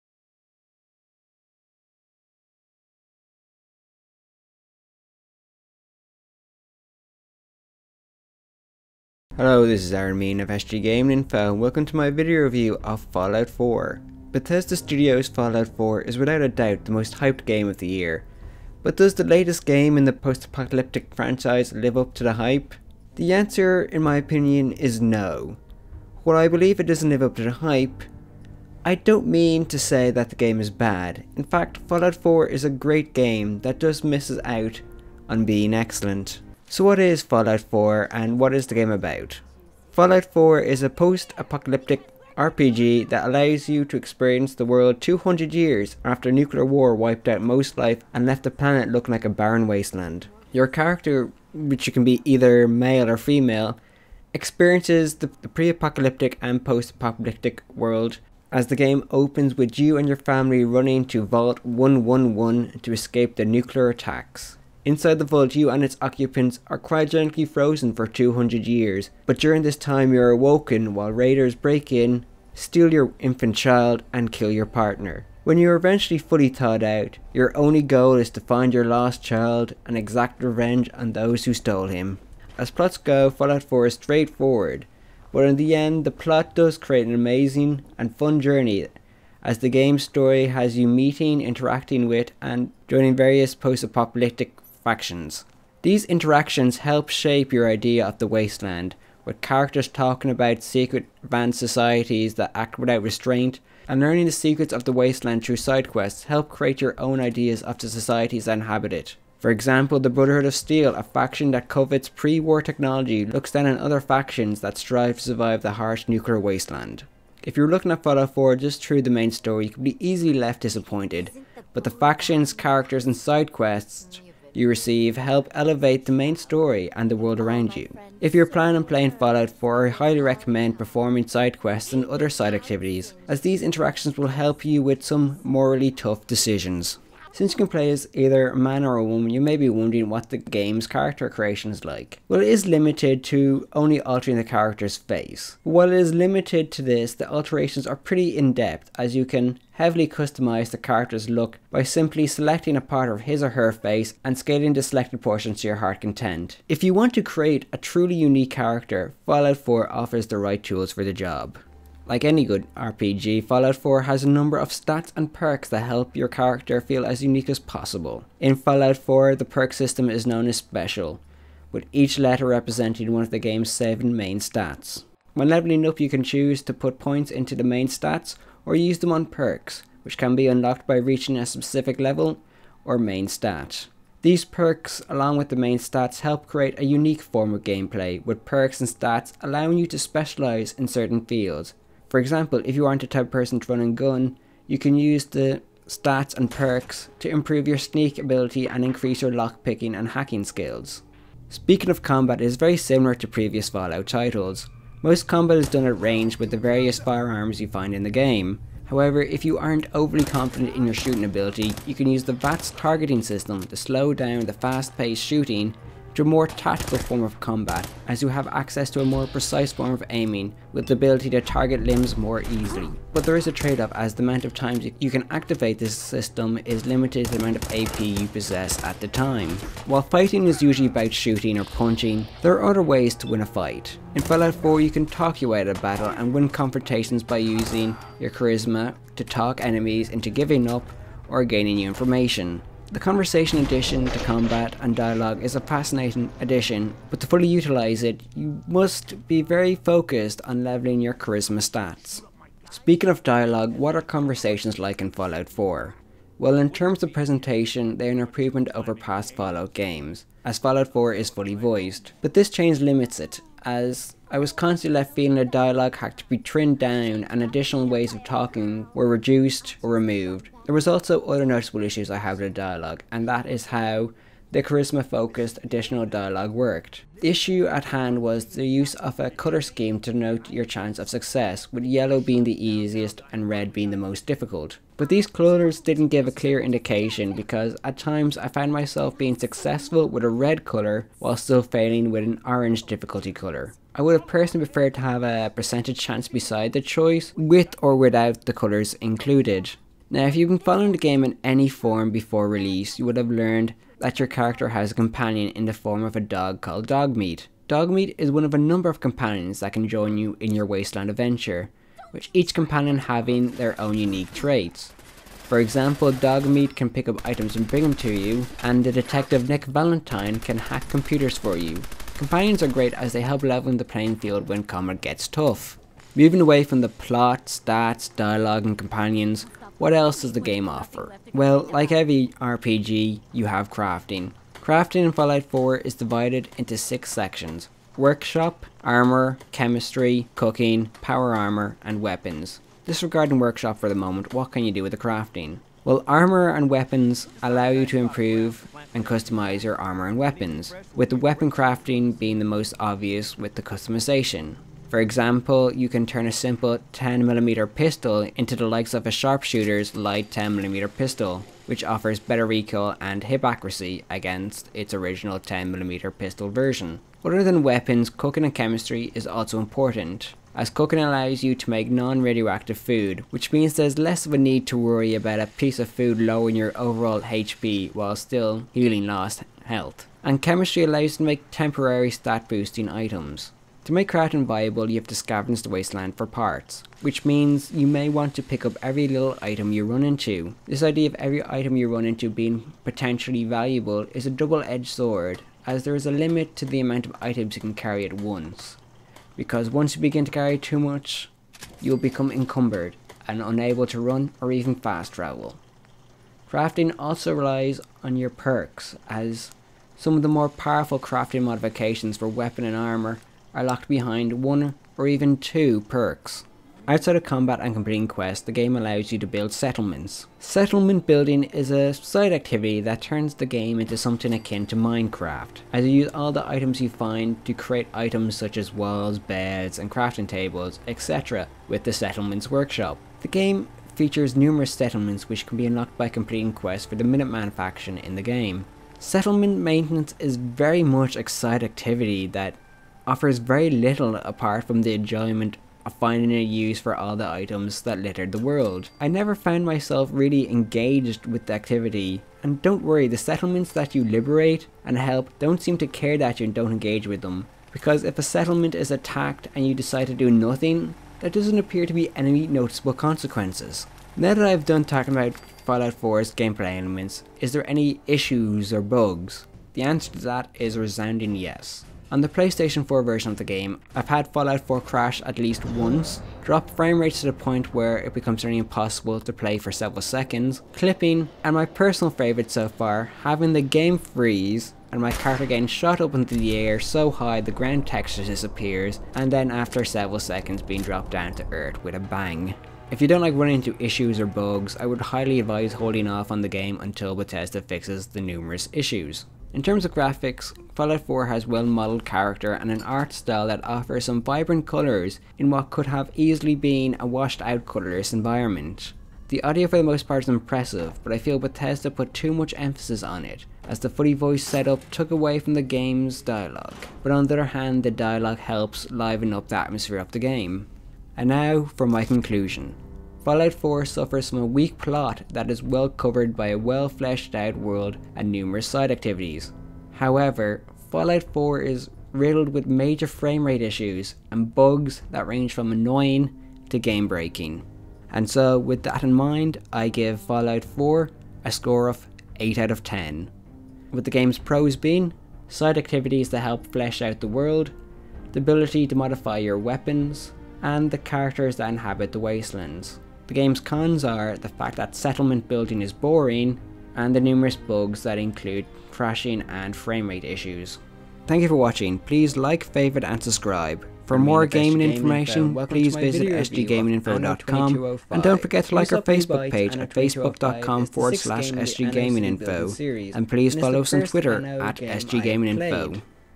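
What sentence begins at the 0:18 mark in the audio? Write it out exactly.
But does the latest game in the post-apocalyptic franchise live up to the hype?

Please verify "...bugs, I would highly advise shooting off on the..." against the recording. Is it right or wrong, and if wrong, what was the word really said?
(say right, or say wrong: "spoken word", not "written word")
wrong: "holding", not "shooting".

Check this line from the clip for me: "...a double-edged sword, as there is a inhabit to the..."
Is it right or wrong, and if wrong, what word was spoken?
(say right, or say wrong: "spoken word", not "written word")
wrong: "limit", not "inhabit".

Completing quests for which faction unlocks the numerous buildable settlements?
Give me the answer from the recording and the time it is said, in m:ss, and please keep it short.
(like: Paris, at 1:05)
Minuteman, at 7:17.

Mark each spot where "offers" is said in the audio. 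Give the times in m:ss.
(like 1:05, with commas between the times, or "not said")
2:39, 5:30, 6:01, 7:23, 8:23.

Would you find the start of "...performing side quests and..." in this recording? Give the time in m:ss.
2:10.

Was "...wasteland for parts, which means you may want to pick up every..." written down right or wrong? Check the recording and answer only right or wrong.
right.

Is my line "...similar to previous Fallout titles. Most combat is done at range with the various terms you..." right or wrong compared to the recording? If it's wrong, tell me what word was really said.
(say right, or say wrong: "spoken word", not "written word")
wrong: "firearms", not "terms".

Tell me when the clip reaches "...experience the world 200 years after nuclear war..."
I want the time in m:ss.
0:43.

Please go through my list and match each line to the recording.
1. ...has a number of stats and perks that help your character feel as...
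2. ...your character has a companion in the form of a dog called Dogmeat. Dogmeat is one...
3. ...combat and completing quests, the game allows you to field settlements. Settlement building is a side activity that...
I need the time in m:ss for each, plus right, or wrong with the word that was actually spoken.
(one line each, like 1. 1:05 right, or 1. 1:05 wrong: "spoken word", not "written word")
1. 2:44 right
2. 5:04 right
3. 6:57 wrong: "build", not "field".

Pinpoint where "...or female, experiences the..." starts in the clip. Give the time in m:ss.
0:53.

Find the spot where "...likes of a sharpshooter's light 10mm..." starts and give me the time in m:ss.
5:58.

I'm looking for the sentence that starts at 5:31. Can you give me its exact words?
Well, like every RPG, you have crafting.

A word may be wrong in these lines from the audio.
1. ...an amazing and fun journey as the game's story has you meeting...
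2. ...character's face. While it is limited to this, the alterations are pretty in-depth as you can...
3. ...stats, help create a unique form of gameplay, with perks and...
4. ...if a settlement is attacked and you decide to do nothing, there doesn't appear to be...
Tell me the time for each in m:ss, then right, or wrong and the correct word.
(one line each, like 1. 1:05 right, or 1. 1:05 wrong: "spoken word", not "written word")
1. 1:27 right
2. 2:24 right
3. 3:05 right
4. 7:38 right.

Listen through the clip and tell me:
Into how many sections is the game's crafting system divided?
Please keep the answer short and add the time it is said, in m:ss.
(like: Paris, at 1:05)
6, at 5:36.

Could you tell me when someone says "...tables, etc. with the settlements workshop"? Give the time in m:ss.
7:10.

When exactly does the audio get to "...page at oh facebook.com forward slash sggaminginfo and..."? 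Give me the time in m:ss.
9:29.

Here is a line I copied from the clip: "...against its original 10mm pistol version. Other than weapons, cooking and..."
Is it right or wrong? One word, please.
right.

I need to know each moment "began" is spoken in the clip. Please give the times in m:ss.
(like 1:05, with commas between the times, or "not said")
not said.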